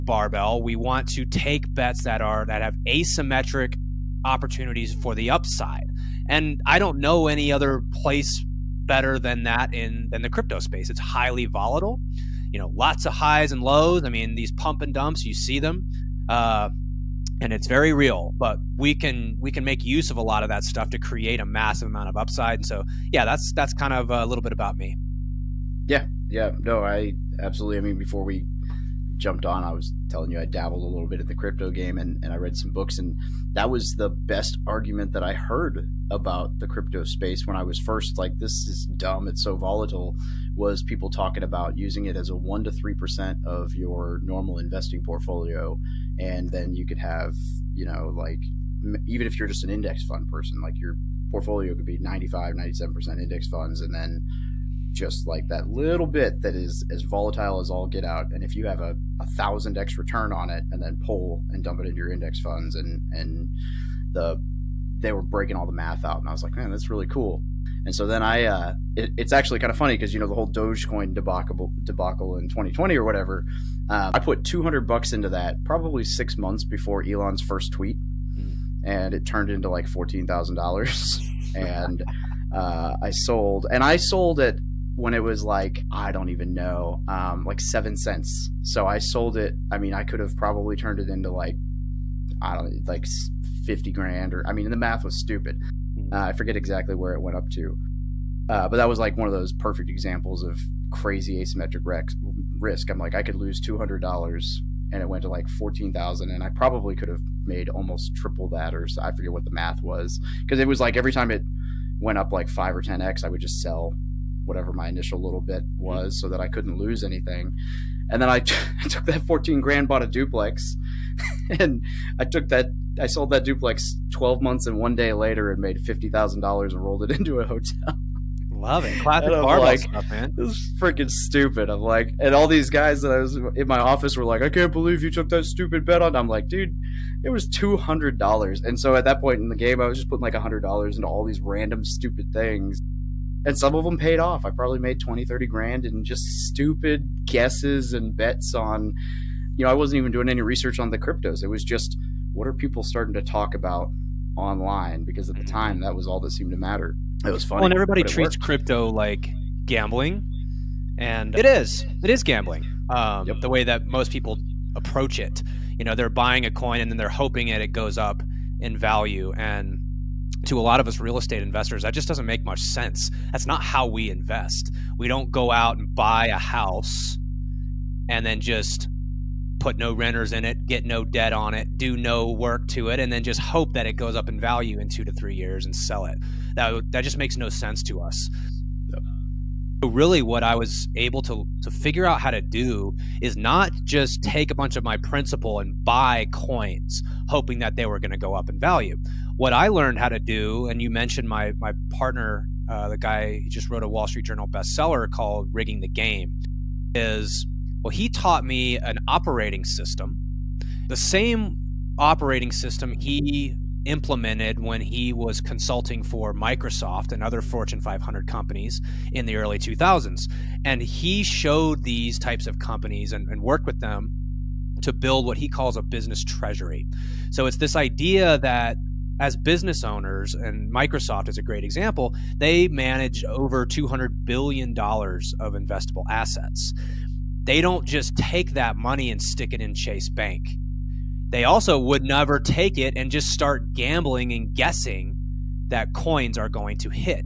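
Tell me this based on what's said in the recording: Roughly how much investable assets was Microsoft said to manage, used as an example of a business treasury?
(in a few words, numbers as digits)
over $200 billion.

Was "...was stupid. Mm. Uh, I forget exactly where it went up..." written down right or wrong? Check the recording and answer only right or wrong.
right.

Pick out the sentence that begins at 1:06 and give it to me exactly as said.
And I was like, man, that's really cool.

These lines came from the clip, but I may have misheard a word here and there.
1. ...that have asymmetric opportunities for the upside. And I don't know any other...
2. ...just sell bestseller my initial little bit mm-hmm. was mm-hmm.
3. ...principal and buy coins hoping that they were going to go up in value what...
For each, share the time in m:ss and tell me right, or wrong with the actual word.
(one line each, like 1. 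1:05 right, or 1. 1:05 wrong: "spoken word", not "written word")
1. 0:02 right
2. 1:53 wrong: "whatever", not "bestseller"
3. 3:14 right.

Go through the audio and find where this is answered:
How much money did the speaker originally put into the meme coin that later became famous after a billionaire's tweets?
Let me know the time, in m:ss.
1:14.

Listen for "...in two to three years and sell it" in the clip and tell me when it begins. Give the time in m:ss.
3:04.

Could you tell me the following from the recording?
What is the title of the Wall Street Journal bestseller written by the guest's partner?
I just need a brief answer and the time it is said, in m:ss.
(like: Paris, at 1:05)
Rigging the Game, at 3:25.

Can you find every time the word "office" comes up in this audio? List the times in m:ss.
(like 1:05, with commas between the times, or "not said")
2:13.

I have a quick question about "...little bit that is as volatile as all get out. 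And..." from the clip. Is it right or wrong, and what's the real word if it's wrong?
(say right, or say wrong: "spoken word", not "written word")
right.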